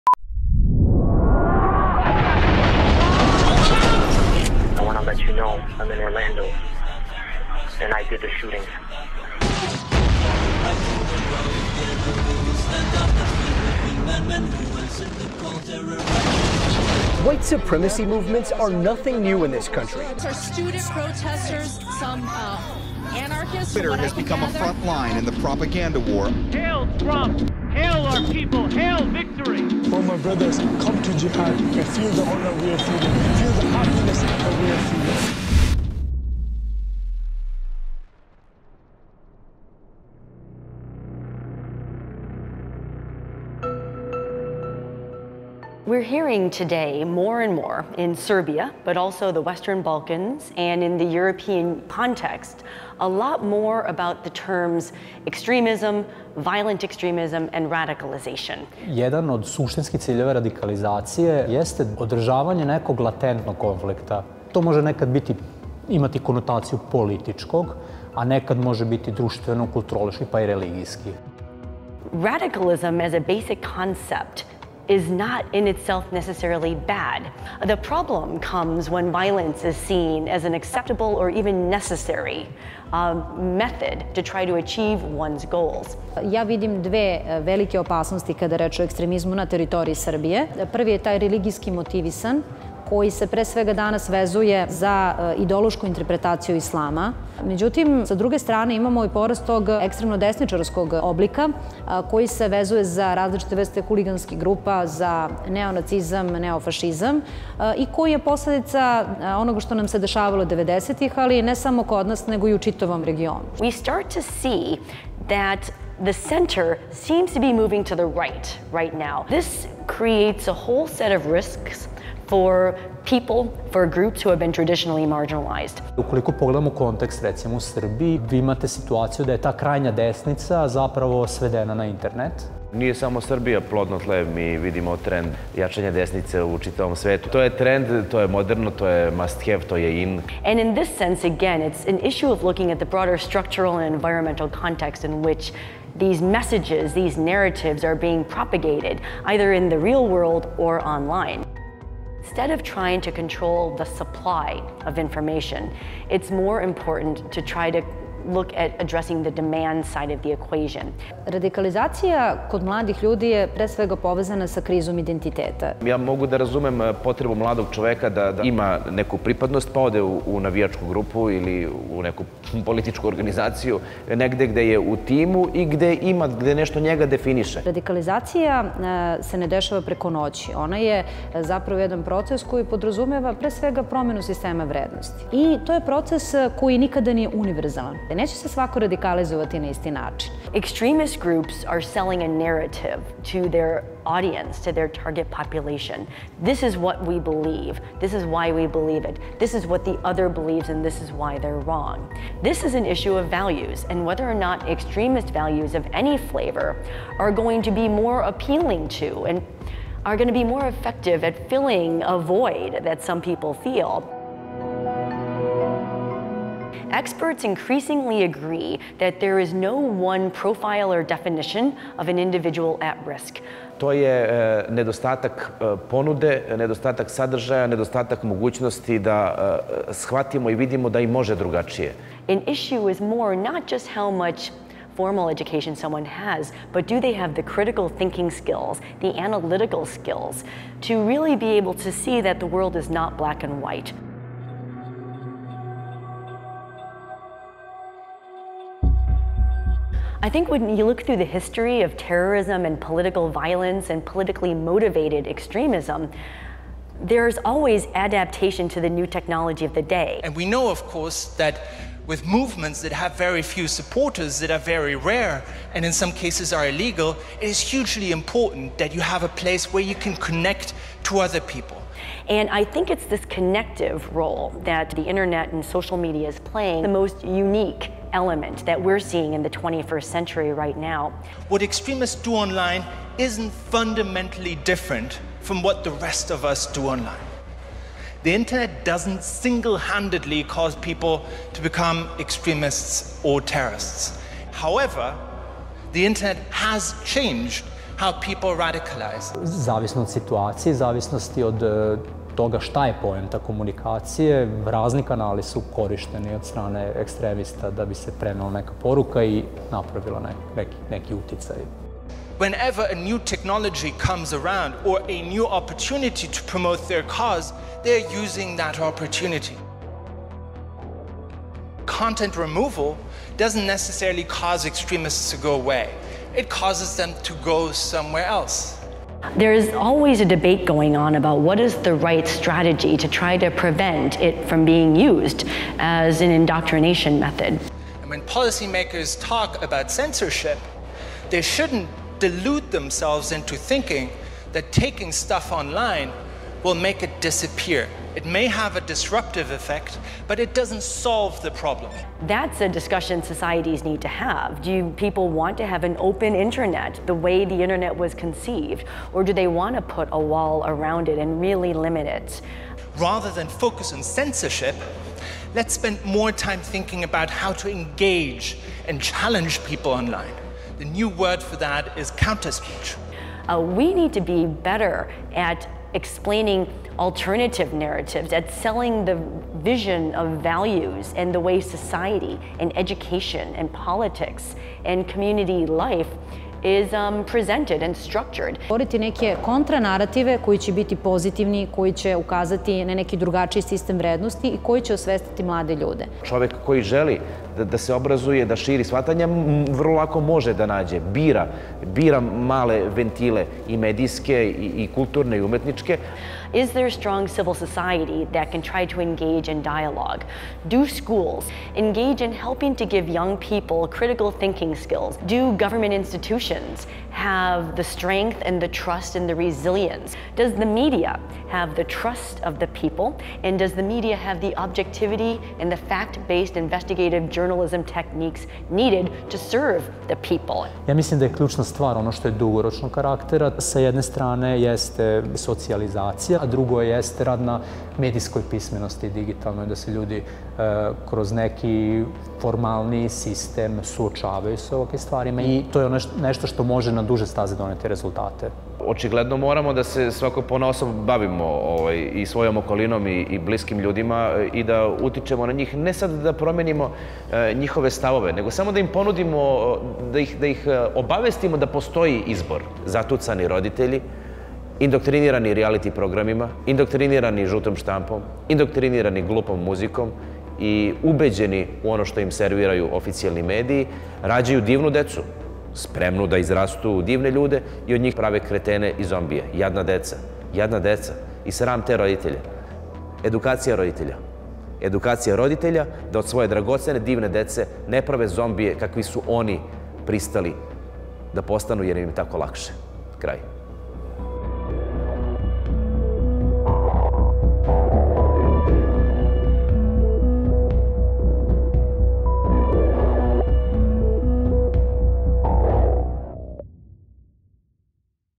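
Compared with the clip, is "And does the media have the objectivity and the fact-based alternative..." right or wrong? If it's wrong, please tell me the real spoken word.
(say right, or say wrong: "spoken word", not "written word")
wrong: "investigative", not "alternative".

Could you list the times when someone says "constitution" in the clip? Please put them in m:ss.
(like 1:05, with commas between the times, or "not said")
not said.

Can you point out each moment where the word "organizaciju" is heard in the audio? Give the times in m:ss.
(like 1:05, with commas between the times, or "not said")
2:53.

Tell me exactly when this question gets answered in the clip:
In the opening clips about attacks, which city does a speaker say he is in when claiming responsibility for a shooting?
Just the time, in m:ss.
0:05.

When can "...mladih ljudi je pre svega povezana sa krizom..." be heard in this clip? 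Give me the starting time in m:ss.
2:42.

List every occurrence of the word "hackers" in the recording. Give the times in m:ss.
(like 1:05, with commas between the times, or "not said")
not said.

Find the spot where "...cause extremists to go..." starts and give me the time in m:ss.
5:24.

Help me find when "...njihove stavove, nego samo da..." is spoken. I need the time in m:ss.
7:37.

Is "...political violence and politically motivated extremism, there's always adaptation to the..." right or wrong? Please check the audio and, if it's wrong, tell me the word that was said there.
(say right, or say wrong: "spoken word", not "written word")
right.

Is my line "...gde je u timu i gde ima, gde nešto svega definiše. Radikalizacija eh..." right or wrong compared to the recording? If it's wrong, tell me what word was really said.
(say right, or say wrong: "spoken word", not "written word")
wrong: "njega", not "svega".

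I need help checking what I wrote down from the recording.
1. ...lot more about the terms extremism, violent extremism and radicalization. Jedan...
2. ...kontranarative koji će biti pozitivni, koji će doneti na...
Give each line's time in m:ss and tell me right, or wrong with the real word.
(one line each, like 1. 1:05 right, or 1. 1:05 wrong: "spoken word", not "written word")
1. 0:53 right
2. 6:29 wrong: "ukazati", not "doneti".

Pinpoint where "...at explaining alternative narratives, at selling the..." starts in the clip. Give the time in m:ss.
6:15.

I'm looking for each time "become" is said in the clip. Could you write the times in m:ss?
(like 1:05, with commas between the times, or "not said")
0:24, 4:51.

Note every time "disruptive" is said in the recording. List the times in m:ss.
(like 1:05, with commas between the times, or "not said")
5:48.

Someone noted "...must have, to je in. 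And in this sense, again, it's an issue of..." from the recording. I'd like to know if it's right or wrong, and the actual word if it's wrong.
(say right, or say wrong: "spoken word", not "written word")
right.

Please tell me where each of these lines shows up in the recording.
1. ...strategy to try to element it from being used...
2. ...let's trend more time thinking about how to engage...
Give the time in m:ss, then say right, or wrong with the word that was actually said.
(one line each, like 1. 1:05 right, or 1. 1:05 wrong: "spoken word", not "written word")
1. 5:32 wrong: "prevent", not "element"
2. 6:05 wrong: "spend", not "trend".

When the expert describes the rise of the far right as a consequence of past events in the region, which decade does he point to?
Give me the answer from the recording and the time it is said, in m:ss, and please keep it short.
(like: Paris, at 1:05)
the 90s, at 1:50.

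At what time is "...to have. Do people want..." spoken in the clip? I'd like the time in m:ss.
5:54.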